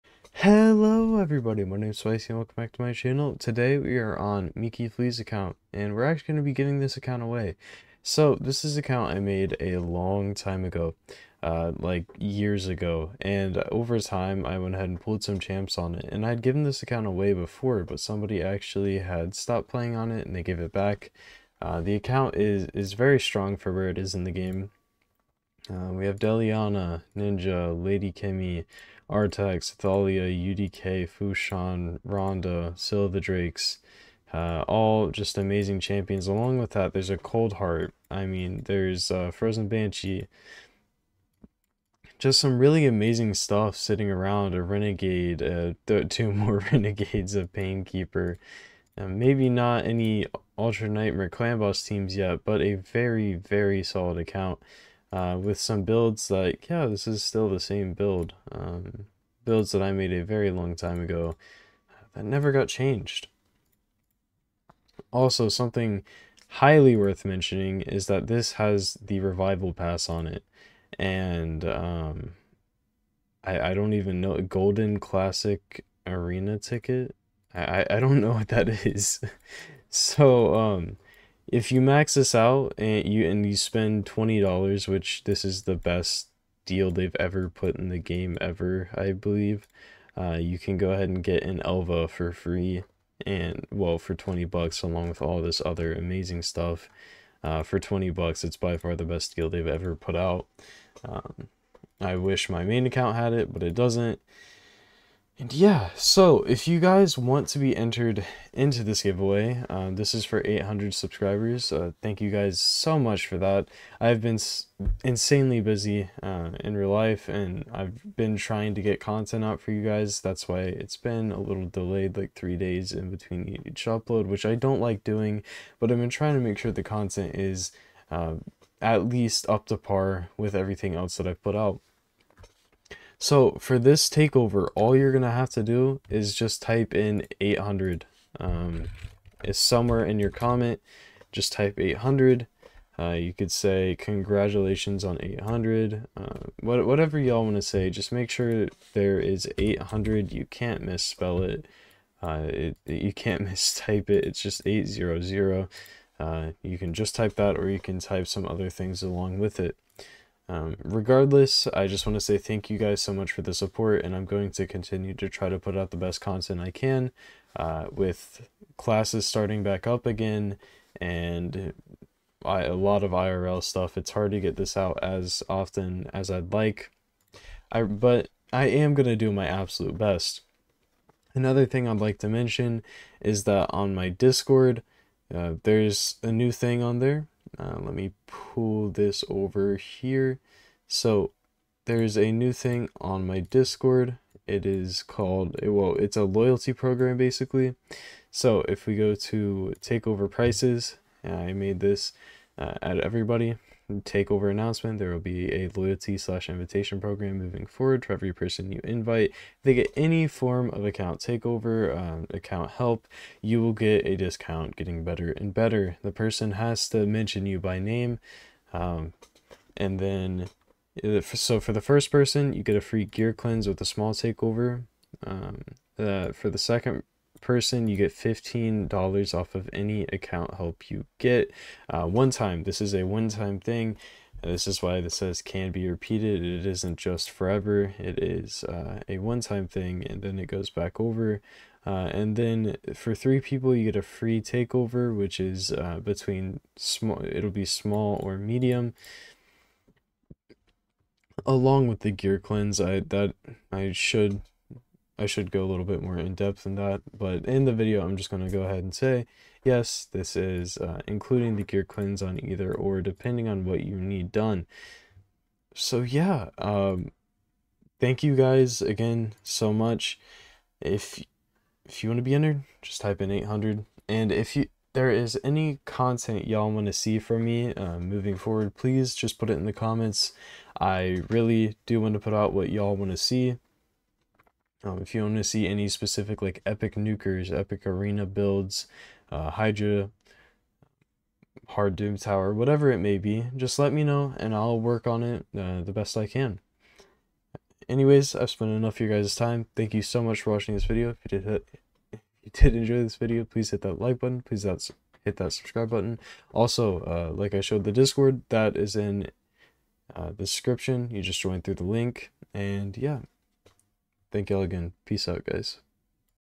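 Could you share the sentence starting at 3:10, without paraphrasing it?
So there's a new thing on my Discord.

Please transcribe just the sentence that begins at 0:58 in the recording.
Um, builds that I made a very long time ago that never got changed.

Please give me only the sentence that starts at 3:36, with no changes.
The person has to mention you by name.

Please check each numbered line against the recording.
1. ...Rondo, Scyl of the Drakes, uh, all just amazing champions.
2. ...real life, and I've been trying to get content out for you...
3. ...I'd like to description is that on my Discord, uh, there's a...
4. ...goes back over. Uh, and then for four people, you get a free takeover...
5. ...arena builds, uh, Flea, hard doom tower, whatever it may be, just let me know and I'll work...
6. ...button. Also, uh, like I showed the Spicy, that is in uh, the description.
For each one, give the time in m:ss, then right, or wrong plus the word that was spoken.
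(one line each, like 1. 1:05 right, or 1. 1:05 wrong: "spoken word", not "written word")
1. 0:32 right
2. 1:56 right
3. 3:01 wrong: "mention", not "description"
4. 4:00 wrong: "three", not "four"
5. 4:47 wrong: "Hydra", not "Flea"
6. 5:05 wrong: "Discord", not "Spicy".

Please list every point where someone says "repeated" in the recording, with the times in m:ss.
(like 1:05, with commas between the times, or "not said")
3:55.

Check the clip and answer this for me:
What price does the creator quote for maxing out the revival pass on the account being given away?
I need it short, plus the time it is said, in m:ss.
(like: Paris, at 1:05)
$20, at 1:24.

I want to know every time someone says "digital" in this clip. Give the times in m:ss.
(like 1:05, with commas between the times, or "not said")
not said.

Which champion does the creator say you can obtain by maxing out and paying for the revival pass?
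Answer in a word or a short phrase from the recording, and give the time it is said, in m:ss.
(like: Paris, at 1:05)
Elva, at 1:31.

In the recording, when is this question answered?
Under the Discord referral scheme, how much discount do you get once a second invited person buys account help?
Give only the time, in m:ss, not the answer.
3:48.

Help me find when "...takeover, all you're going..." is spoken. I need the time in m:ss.
2:14.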